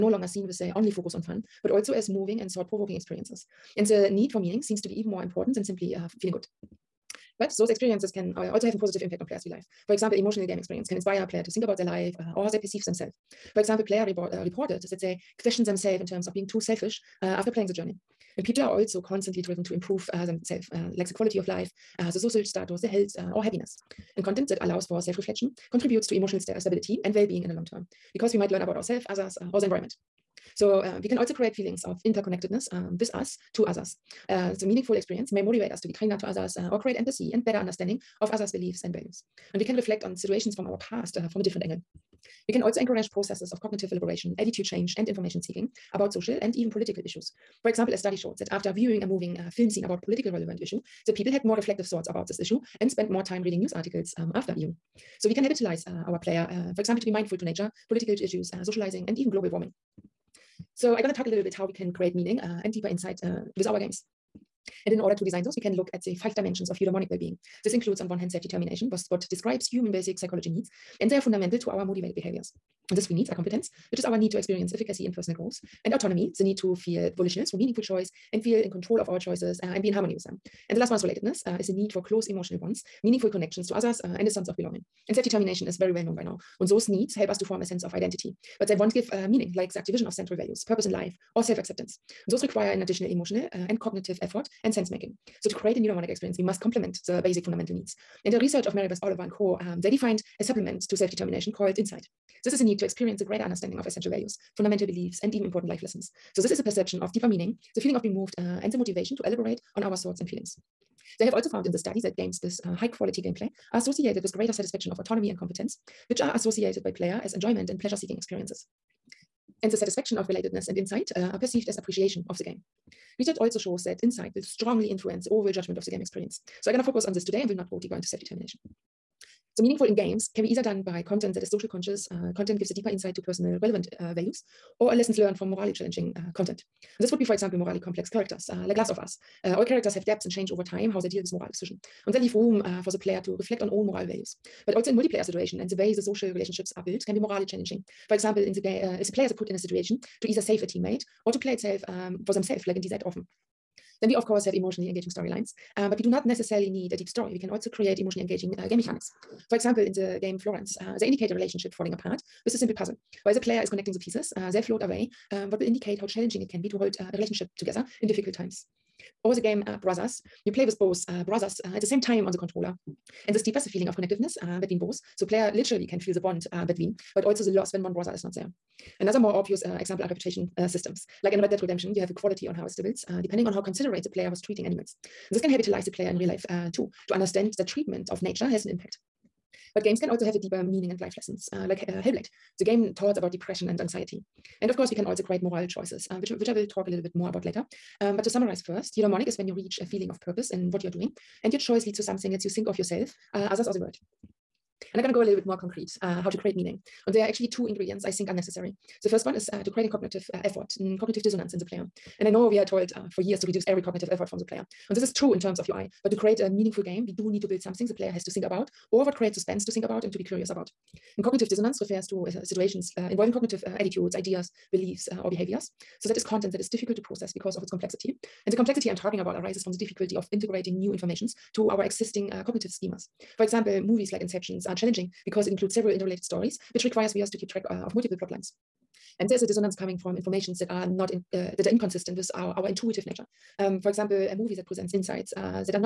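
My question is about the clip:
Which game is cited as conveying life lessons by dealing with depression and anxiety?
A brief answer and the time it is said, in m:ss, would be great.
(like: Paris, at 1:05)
Hellblade, at 3:12.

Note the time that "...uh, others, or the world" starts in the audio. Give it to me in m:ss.
3:23.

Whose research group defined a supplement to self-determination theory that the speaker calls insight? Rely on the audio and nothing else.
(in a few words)
Mary Beth Oliver.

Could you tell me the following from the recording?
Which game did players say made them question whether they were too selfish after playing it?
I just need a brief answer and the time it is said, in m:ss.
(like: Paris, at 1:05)
Journey, at 0:17.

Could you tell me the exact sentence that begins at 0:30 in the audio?
So uh, we can also create feelings of interconnectedness um, with us to others.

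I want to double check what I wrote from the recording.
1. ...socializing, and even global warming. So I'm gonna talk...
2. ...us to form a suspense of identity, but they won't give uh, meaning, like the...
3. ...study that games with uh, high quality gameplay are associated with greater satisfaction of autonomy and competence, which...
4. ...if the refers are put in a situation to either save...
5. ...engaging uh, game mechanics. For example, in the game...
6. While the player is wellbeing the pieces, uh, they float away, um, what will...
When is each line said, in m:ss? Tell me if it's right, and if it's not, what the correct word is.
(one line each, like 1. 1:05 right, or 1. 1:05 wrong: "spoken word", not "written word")
1. 0:58 right
2. 1:27 wrong: "sense", not "suspense"
3. 1:51 right
4. 2:29 wrong: "players", not "refers"
5. 2:38 right
6. 2:43 wrong: "connecting", not "wellbeing".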